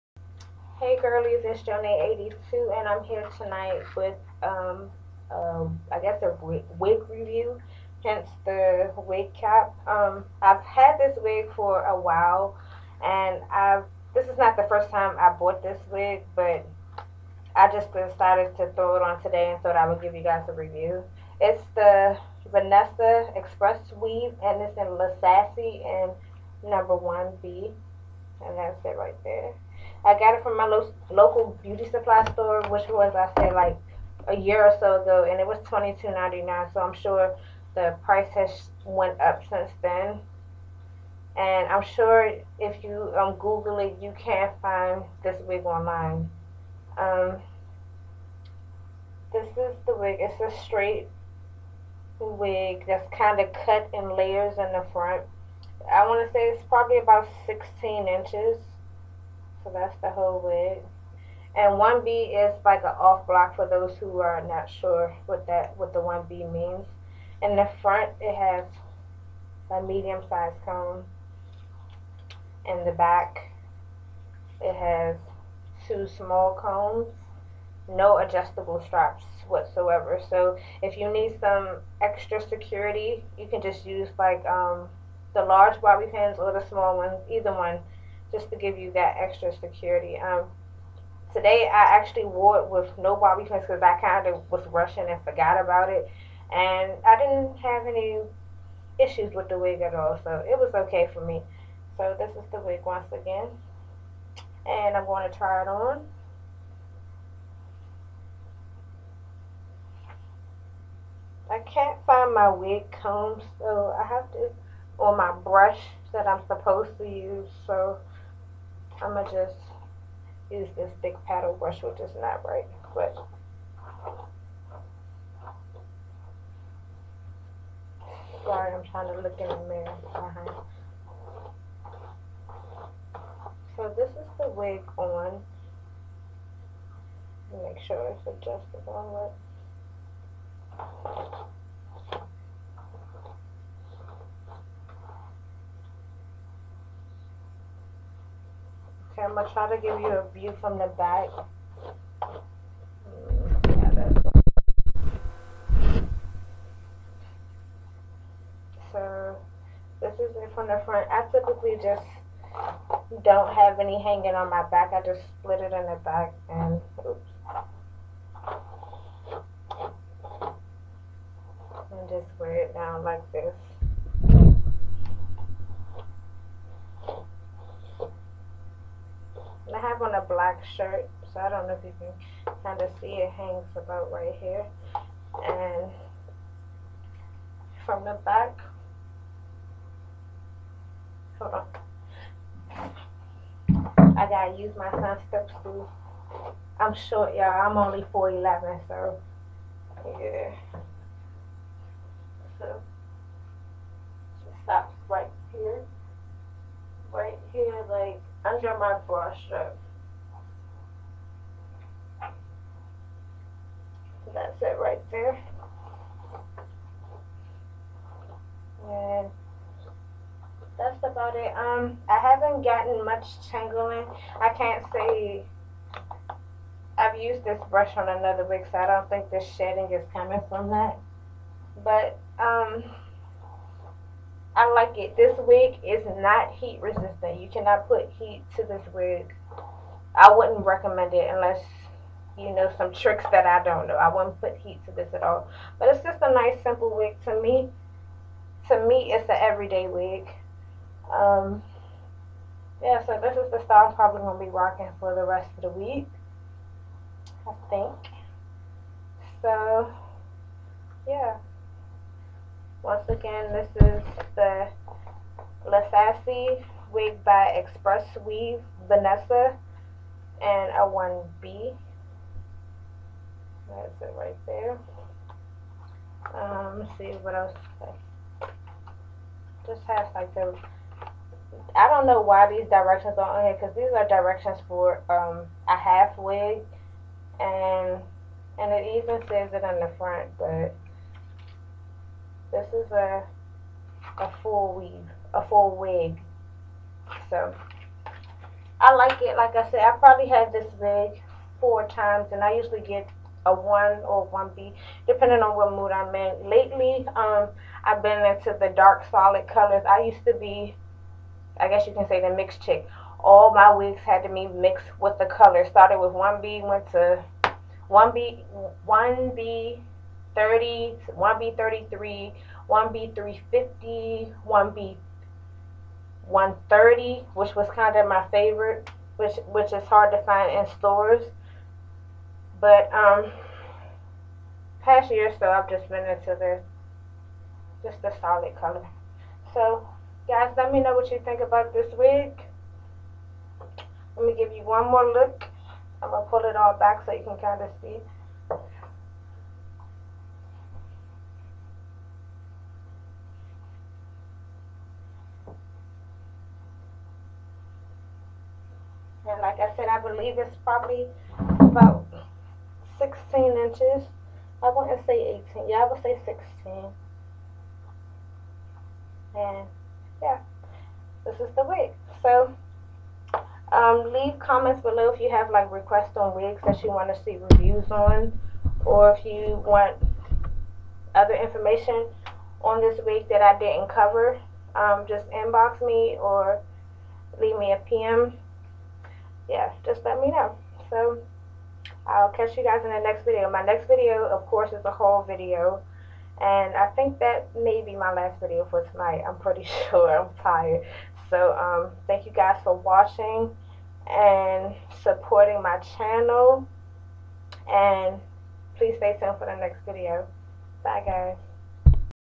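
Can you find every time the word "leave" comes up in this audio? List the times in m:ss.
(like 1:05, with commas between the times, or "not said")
6:14, 6:27.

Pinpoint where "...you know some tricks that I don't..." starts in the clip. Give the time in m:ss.
4:02.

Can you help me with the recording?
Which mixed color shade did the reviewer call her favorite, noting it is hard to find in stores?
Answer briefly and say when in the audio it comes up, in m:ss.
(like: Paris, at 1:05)
1B 130, at 5:24.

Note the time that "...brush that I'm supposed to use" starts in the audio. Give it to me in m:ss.
1:55.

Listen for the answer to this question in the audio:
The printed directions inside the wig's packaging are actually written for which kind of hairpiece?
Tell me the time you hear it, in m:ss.
4:45.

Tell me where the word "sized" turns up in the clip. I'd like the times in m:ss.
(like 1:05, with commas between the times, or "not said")
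1:10.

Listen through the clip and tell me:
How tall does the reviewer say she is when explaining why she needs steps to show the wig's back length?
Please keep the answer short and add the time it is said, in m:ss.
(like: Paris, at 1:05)
4'11, at 3:18.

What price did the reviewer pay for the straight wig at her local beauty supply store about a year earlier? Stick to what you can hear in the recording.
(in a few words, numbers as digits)
$22.99.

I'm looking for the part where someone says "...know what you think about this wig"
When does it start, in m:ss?
5:40.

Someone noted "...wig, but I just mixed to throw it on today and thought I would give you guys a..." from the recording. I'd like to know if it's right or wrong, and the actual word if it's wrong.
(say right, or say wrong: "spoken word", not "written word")
wrong: "decided", not "mixed".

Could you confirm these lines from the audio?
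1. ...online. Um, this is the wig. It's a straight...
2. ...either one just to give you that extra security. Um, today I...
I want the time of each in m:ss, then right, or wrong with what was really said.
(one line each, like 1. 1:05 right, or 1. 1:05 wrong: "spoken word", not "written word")
1. 0:45 right
2. 1:27 right.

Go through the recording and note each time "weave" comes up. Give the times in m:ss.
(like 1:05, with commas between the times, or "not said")
0:24, 4:28, 4:54.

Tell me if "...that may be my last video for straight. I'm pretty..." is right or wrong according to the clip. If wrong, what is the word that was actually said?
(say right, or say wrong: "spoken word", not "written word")
wrong: "tonight", not "straight".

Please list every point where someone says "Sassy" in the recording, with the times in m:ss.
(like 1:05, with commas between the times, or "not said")
0:25, 4:25.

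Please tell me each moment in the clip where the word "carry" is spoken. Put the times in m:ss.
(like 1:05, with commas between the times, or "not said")
not said.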